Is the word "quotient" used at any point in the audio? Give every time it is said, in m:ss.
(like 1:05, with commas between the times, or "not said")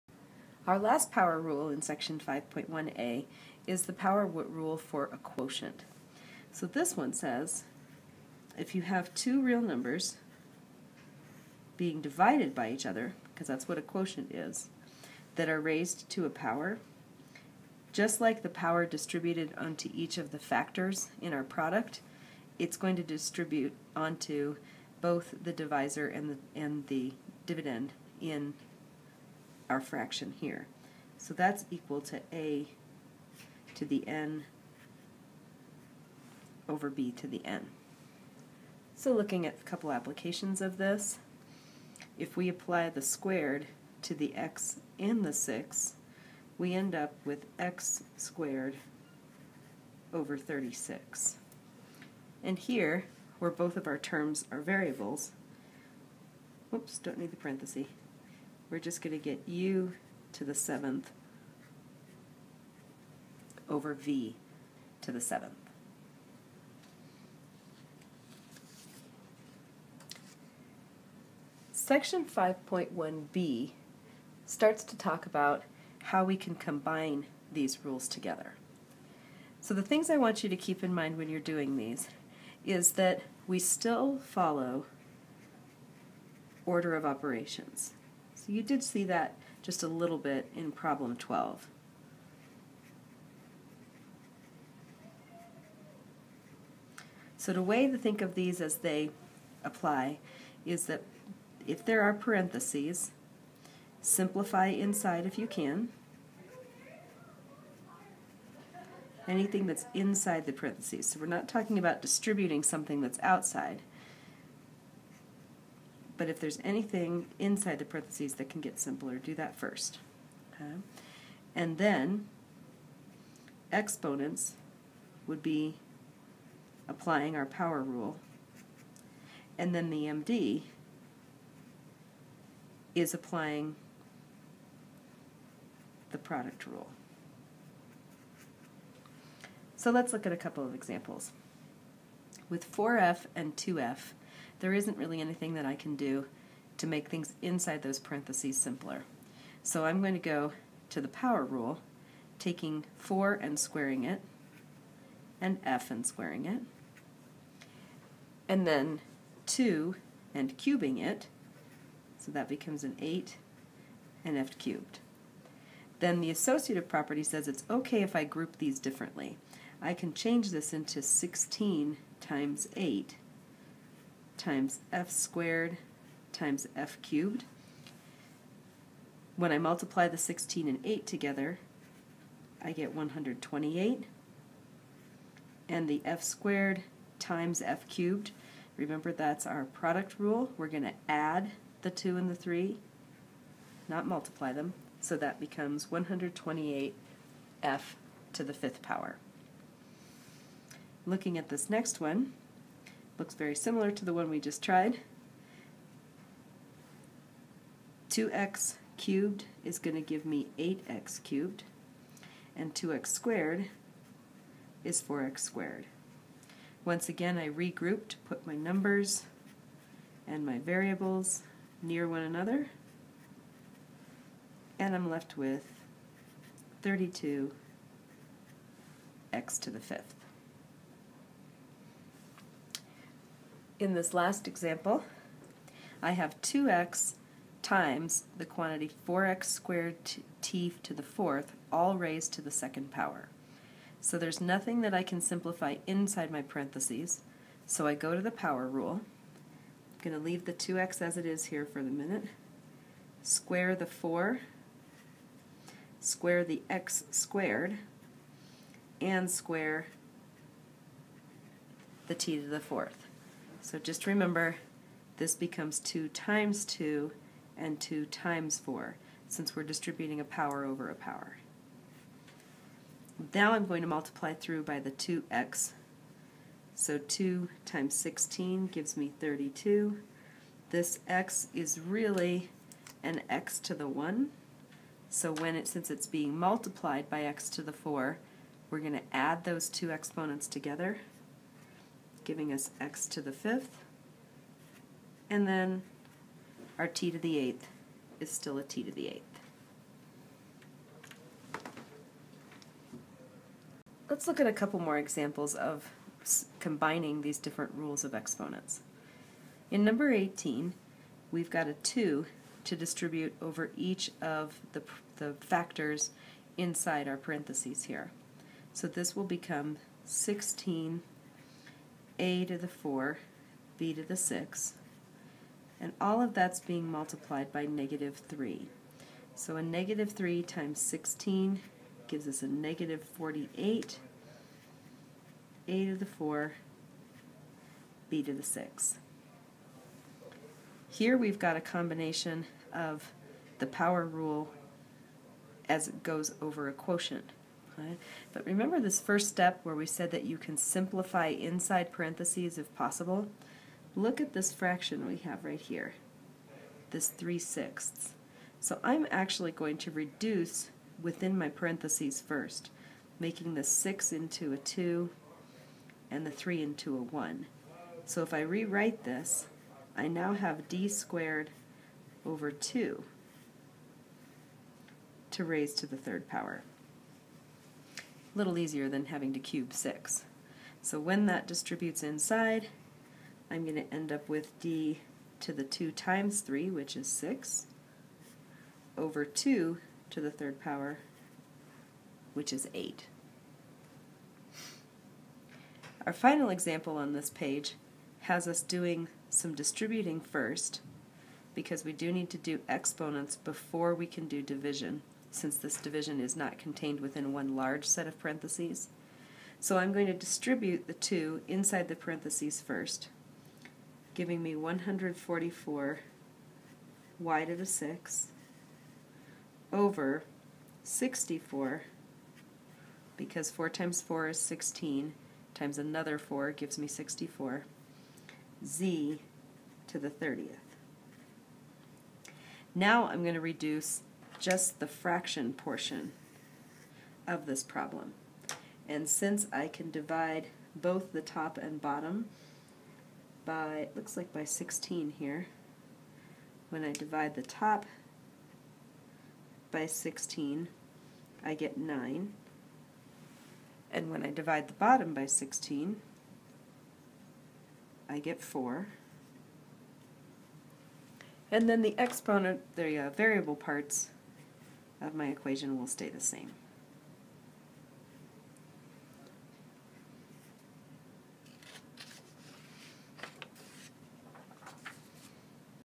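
0:05, 0:13, 5:46.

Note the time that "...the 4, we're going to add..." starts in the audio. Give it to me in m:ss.
4:47.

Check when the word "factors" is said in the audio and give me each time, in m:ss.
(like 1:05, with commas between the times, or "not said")
0:20, 5:15.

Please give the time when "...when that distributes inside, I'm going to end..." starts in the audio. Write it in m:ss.
6:20.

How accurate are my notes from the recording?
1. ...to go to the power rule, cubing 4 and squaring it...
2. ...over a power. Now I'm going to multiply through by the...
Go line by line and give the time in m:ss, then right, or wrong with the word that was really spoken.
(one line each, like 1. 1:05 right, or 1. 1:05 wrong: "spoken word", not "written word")
1. 2:30 wrong: "taking", not "cubing"
2. 4:30 right.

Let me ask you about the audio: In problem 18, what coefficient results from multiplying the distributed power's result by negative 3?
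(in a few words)
-48.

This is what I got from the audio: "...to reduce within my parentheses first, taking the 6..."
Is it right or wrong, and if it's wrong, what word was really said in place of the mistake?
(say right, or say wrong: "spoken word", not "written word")
wrong: "making", not "taking".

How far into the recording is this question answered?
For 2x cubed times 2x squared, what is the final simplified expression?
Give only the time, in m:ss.
3:46.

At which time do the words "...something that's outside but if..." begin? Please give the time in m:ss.
1:52.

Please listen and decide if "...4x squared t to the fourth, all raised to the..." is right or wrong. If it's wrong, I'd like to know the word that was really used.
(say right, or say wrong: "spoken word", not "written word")
right.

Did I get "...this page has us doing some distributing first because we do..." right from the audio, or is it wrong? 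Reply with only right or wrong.
right.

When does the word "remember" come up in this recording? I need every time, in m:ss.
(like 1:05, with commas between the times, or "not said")
3:08, 4:24, 5:48.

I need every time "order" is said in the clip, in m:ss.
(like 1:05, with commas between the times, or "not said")
1:26.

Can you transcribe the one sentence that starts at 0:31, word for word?
So that's equal to a to the n over b to the n.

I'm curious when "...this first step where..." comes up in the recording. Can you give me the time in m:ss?
5:48.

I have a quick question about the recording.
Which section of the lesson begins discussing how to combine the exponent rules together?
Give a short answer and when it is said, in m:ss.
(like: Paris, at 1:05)
5.1b, at 1:12.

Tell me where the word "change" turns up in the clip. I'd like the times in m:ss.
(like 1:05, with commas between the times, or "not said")
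2:50.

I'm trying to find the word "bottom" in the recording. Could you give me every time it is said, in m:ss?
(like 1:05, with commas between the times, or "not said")
7:21, 7:34.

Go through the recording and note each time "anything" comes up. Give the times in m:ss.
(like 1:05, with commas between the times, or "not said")
1:49, 1:56, 2:25.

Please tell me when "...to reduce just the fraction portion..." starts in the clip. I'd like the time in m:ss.
7:13.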